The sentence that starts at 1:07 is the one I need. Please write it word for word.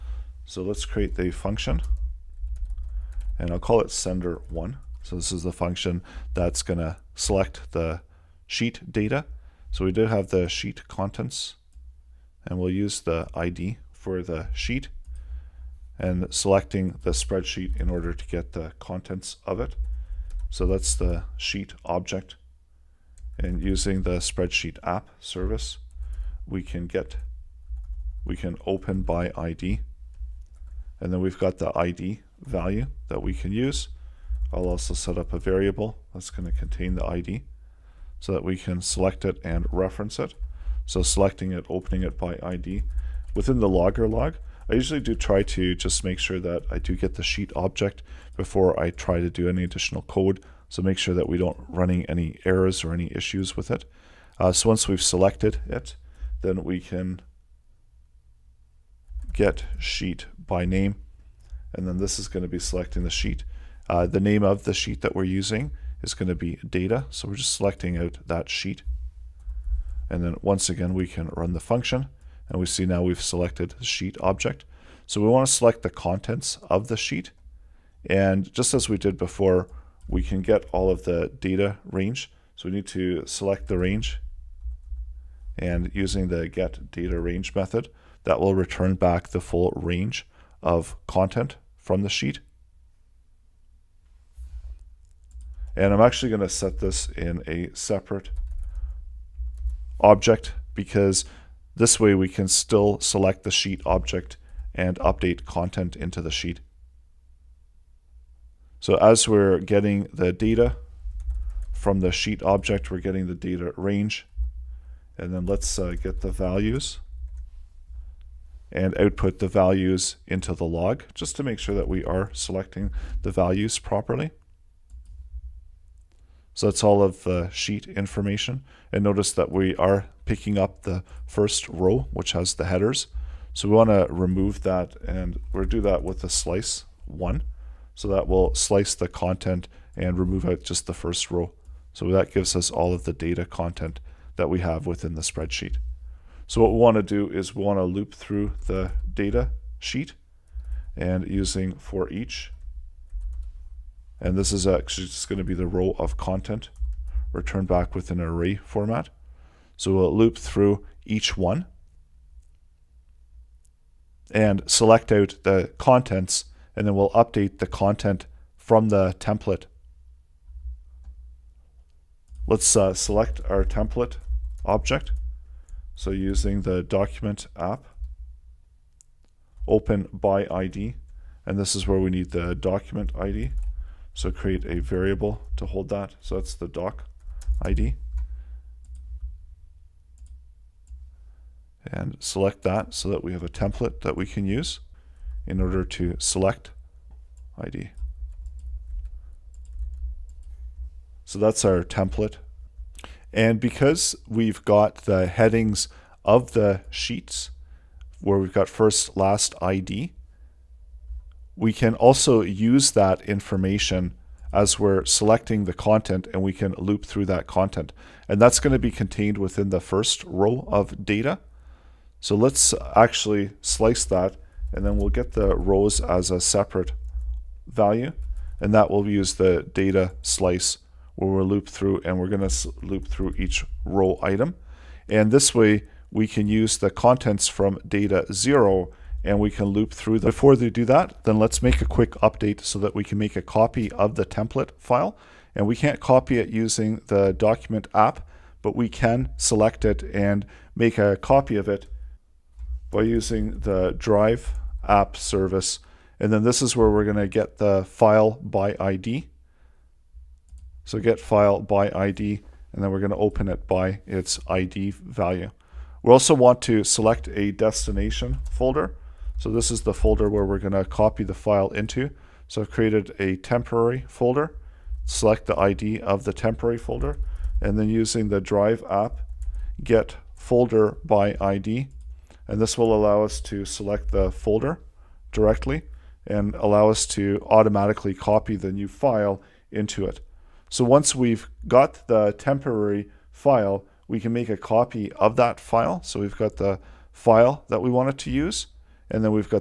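So we're just selecting out that sheet.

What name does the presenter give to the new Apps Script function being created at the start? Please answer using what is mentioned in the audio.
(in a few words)
sender1.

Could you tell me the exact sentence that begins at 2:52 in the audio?
Let's uh, select our template object.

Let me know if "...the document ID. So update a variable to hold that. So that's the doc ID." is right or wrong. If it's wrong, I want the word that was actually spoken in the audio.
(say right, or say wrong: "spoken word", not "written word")
wrong: "create", not "update".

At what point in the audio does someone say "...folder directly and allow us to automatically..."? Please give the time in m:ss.
4:44.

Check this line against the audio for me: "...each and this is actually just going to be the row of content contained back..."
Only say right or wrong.
wrong.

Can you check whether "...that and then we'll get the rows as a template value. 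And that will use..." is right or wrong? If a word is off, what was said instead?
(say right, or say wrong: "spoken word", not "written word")
wrong: "separate", not "template".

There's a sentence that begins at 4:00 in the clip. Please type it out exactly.
Before they do that, then let's make a quick update so that we can make a copy of the template file.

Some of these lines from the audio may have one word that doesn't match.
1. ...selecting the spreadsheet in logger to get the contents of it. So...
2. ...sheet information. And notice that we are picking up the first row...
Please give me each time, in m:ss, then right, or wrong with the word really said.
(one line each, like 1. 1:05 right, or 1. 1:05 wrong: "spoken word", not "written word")
1. 0:16 wrong: "order", not "logger"
2. 2:07 right.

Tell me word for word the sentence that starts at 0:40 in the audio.
So selecting it, opening it by ID.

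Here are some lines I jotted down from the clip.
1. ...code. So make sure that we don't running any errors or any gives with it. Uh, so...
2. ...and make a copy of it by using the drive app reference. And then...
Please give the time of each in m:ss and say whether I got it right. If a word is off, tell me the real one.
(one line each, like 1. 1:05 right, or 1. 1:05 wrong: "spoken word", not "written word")
1. 0:50 wrong: "issues", not "gives"
2. 4:10 wrong: "service", not "reference".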